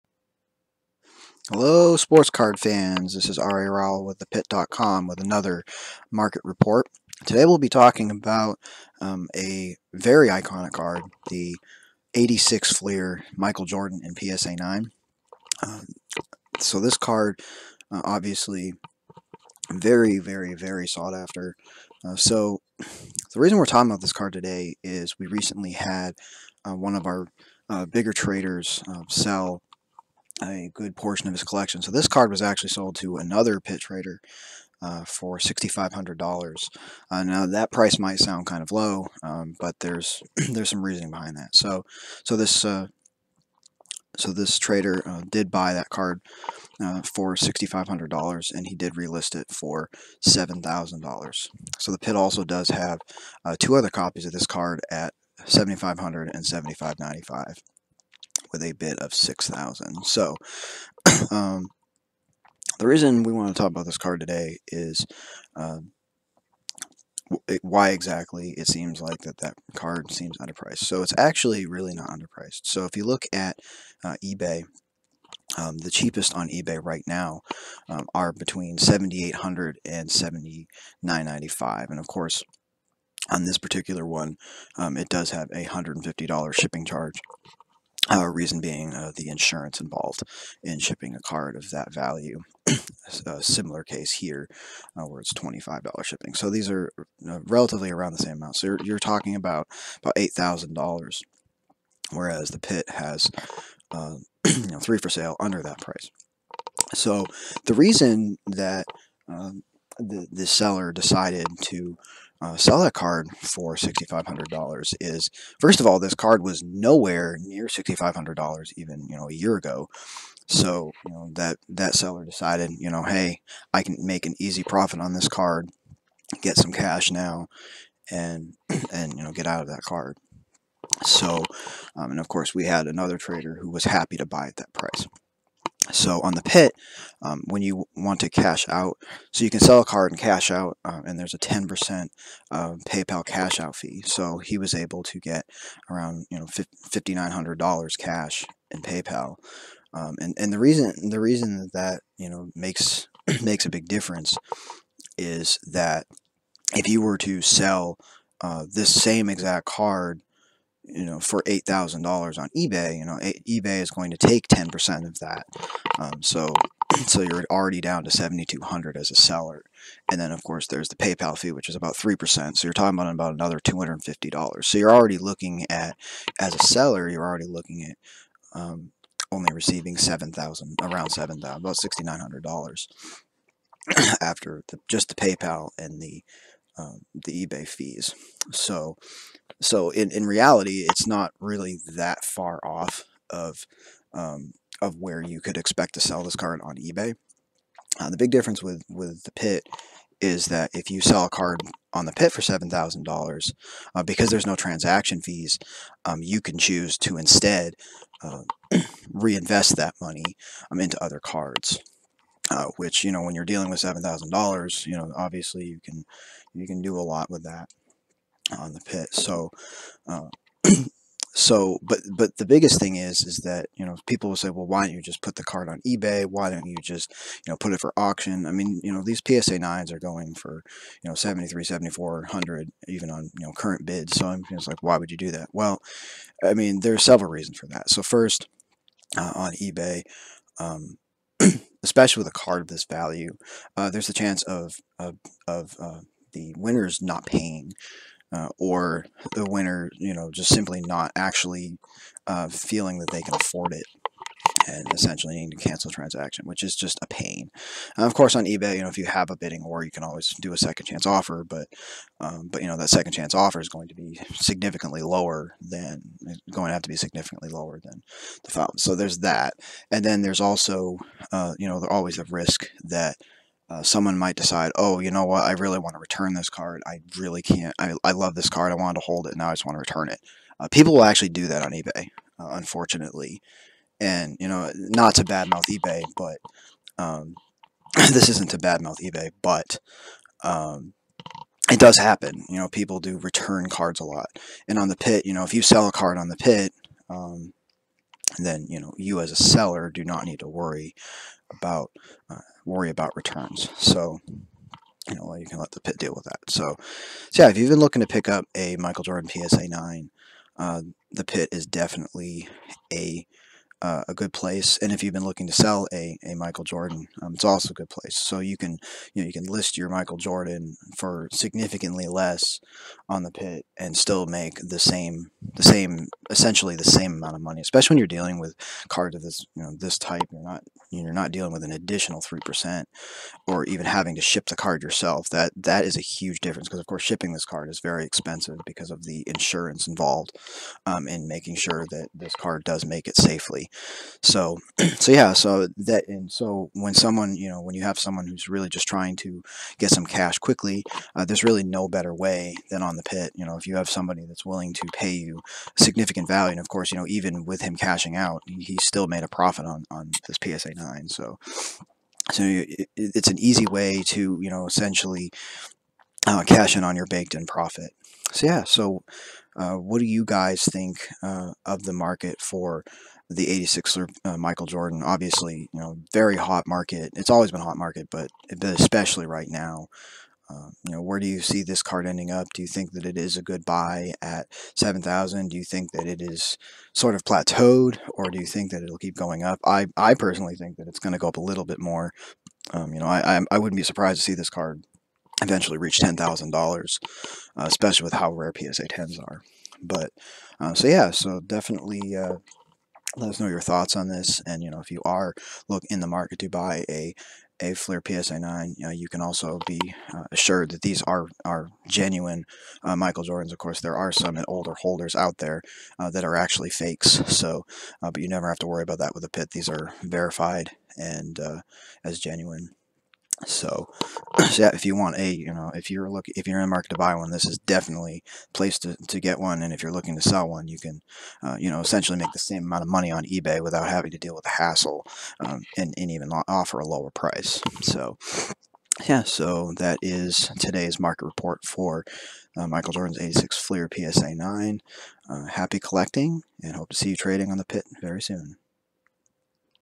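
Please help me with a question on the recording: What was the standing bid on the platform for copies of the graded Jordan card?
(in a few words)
6,000.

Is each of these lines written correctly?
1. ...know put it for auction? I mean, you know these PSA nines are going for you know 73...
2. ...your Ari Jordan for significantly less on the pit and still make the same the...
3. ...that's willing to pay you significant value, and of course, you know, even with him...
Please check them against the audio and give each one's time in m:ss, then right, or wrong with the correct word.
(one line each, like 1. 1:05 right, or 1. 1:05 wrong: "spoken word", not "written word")
1. 3:47 right
2. 5:19 wrong: "Michael", not "Ari"
3. 5:54 right.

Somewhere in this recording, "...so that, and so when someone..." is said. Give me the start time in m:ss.
5:45.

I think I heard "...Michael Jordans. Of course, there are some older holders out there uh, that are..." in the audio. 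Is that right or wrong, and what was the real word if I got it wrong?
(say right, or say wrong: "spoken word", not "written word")
right.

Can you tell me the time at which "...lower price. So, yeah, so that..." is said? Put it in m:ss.
7:16.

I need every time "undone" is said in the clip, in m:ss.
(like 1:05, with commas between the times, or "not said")
not said.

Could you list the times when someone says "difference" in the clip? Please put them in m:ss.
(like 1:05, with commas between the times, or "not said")
2:33, 3:18, 5:36.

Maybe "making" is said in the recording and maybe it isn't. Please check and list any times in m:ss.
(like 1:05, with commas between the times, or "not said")
5:41.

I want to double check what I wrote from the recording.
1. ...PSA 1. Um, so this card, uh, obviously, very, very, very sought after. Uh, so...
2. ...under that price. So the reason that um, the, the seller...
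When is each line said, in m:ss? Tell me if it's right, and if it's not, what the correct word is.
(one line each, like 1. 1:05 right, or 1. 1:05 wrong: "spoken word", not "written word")
1. 0:14 wrong: "9", not "1"
2. 1:45 right.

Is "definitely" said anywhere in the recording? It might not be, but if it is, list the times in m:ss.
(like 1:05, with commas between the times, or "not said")
5:11, 6:41, 7:07.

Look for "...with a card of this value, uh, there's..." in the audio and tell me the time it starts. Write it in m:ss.
4:02.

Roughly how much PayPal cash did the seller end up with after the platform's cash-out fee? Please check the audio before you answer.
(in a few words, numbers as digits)
$5,900.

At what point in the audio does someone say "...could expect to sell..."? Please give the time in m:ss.
3:15.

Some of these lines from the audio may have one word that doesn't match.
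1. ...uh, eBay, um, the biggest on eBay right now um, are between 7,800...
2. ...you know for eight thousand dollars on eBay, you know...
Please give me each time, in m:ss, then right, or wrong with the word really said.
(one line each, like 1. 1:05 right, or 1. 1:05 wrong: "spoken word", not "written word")
1. 1:14 wrong: "cheapest", not "biggest"
2. 2:40 right.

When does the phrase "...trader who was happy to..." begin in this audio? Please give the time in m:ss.
2:13.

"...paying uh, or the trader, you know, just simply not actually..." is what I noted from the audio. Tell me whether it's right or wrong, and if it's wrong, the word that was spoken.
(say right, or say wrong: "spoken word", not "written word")
wrong: "winner", not "trader".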